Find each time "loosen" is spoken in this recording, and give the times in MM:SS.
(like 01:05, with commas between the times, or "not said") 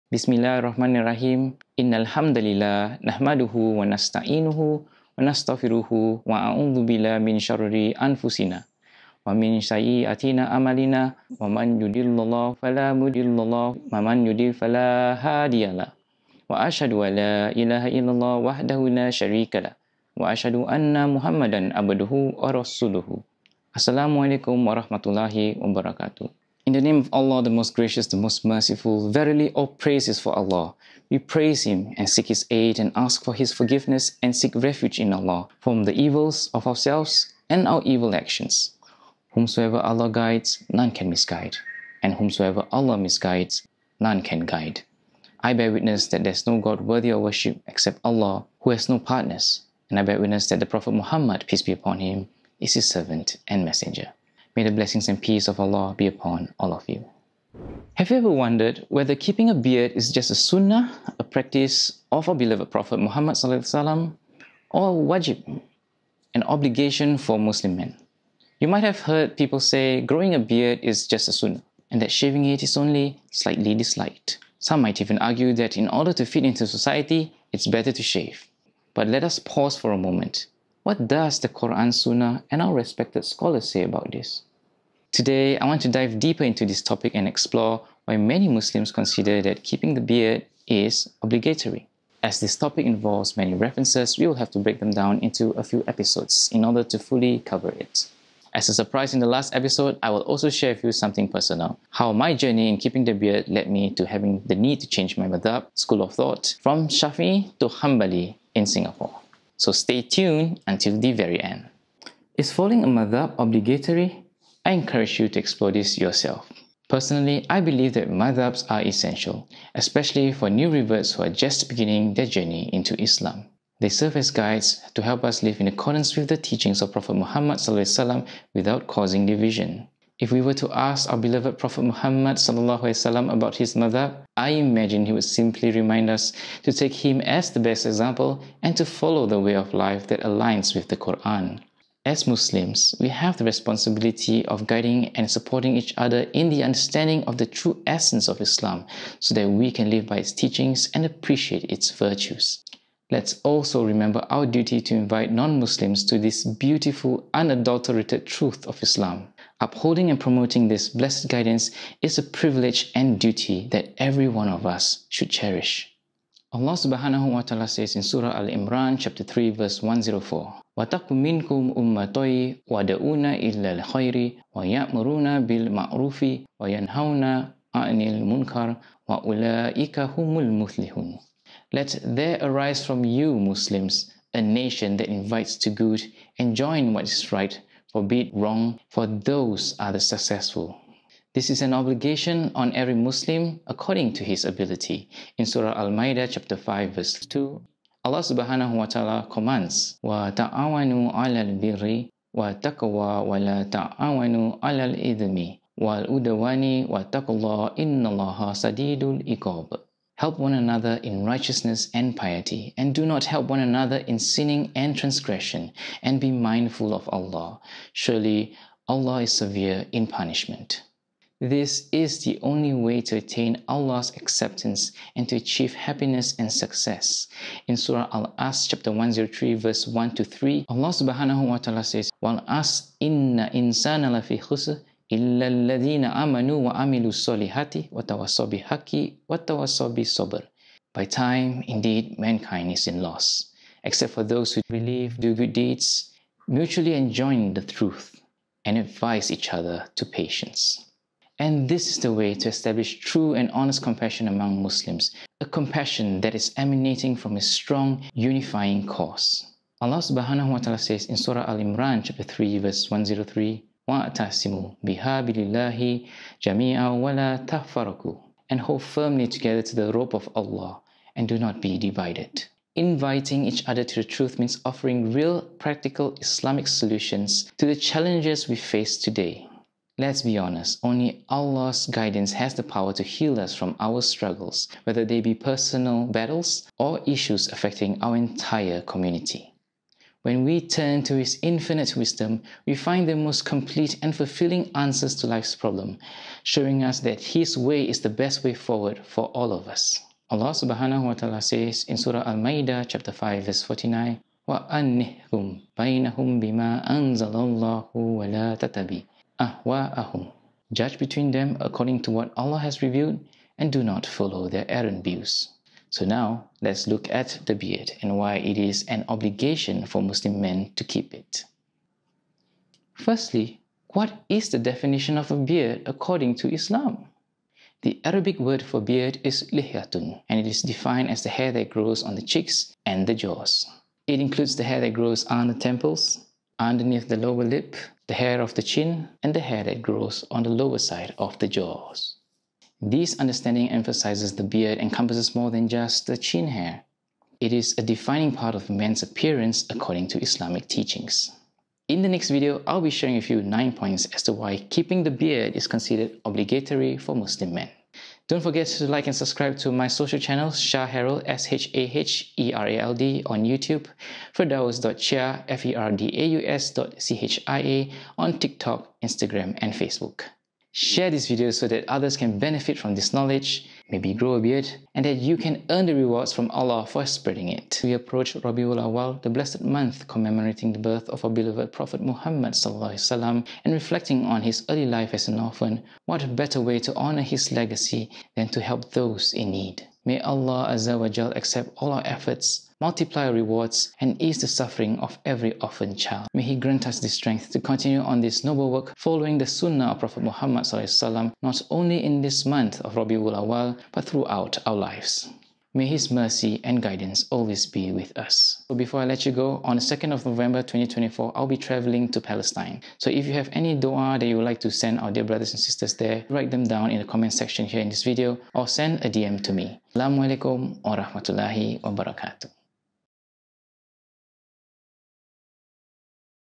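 not said.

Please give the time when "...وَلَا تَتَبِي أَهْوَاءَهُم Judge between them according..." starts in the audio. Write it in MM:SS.
05:07.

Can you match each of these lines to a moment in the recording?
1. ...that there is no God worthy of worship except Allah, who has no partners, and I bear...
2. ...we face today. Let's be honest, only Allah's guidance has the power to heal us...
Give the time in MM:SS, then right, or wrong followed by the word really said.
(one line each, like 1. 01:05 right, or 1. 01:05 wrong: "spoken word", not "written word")
1. 00:46 right
2. 04:38 right.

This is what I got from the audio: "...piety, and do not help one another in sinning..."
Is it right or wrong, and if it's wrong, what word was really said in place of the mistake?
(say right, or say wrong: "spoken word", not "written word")
right.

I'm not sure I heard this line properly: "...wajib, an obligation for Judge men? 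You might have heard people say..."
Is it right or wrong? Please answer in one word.
wrong.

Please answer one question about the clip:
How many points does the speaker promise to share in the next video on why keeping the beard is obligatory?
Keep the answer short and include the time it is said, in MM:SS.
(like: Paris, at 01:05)
9, at 05:53.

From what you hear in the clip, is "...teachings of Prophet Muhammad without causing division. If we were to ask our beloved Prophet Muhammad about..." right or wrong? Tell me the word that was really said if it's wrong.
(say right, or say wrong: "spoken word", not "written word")
right.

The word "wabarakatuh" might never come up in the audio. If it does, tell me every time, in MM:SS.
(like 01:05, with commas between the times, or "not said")
00:25, 07:01.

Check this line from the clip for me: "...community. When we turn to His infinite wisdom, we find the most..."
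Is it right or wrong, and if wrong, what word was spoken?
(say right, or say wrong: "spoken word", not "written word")
right.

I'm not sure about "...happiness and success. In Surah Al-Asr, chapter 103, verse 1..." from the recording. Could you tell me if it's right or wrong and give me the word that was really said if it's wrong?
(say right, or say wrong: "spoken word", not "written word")
right.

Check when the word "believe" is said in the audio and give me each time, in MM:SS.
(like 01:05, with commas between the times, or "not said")
01:57, 04:04.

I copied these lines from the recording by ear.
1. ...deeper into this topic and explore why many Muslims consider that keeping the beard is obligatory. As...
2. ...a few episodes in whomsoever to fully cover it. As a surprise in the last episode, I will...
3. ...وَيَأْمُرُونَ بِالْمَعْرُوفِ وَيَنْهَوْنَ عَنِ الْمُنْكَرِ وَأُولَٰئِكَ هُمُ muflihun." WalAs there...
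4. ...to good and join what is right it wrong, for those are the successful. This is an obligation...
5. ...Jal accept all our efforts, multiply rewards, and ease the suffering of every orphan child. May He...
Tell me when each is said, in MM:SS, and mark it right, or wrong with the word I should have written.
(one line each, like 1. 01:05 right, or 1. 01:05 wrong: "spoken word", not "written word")
1. 01:26 right
2. 01:35 wrong: "order", not "whomsoever"
3. 02:54 wrong: "Let", not "WalAs"
4. 03:05 right
5. 06:31 right.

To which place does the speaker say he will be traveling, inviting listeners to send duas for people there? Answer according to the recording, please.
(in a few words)
Palestine.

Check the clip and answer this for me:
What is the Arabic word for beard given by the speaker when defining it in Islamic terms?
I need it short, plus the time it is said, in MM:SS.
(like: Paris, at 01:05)
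lihyatun, at 05:29.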